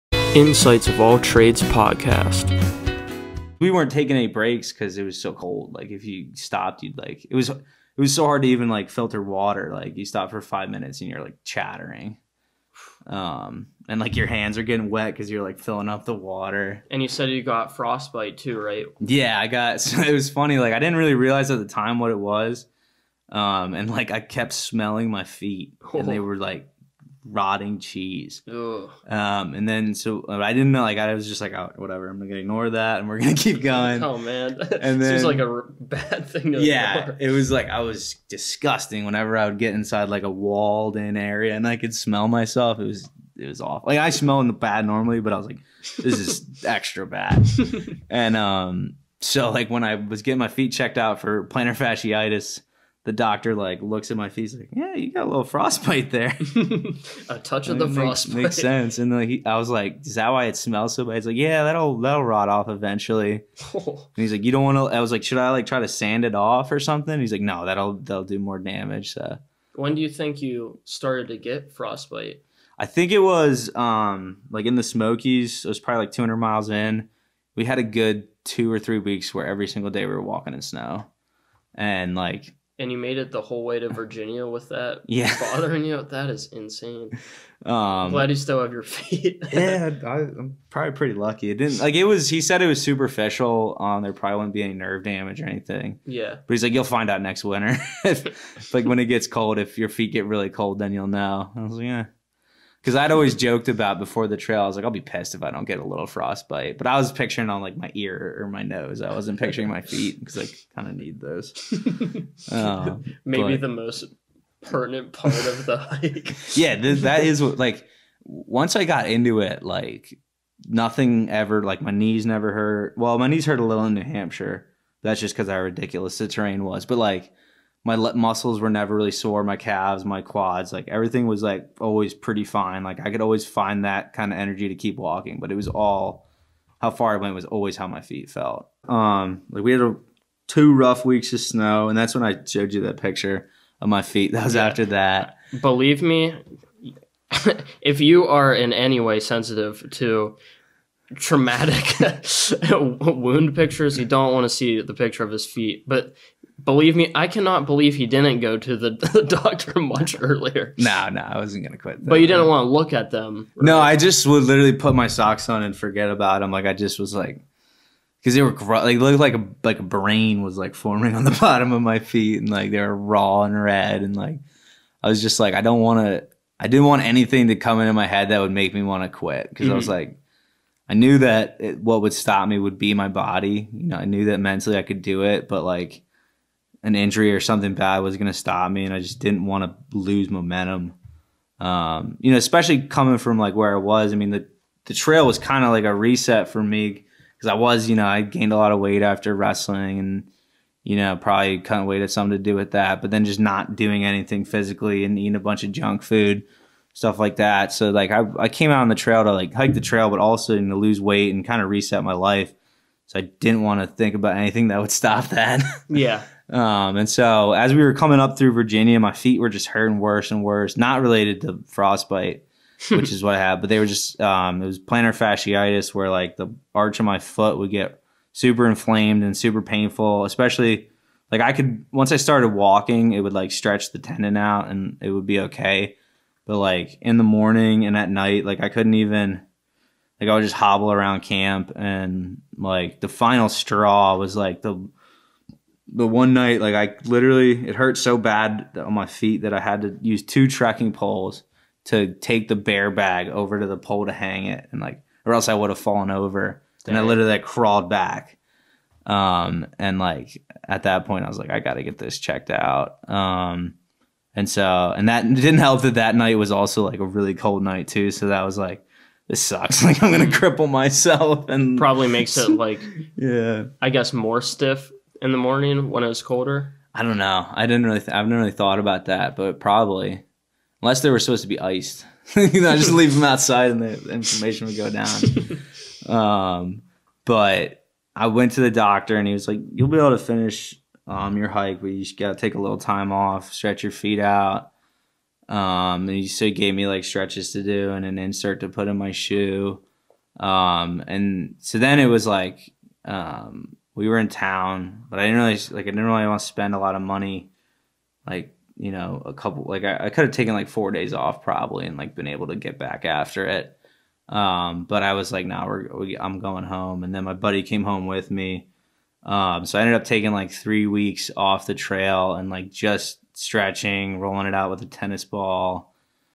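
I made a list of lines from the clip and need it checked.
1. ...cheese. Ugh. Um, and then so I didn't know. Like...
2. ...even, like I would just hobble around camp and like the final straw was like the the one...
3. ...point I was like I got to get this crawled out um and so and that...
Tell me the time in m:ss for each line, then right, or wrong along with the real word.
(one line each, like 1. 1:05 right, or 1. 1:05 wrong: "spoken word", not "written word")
1. 0:27 right
2. 3:58 right
3. 4:21 wrong: "checked", not "crawled".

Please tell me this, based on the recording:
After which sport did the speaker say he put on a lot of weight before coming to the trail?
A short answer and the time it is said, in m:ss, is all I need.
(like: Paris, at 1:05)
Wrestling, at 3:19.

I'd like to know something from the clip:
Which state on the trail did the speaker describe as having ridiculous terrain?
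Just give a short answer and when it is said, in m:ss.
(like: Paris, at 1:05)
New Hampshire, at 2:03.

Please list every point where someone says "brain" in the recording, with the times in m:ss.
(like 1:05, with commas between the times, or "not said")
2:49.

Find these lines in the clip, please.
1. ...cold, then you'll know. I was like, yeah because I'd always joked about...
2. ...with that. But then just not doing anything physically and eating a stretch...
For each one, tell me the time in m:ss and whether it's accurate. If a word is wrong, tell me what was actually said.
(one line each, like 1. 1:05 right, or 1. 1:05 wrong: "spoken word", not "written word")
1. 1:40 right
2. 3:22 wrong: "bunch", not "stretch".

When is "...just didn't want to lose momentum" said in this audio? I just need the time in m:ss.
3:08.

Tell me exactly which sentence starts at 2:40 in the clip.
No, no, I wasn't gonna quit.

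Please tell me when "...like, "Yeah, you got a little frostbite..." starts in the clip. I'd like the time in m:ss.
0:54.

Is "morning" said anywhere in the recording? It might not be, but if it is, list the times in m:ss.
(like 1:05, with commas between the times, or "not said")
3:57, 4:35.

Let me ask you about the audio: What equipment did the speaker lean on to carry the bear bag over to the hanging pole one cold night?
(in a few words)
2 trekking poles.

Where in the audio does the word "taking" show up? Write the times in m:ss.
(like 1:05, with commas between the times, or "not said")
0:03, 5:20.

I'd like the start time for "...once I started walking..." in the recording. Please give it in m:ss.
3:51.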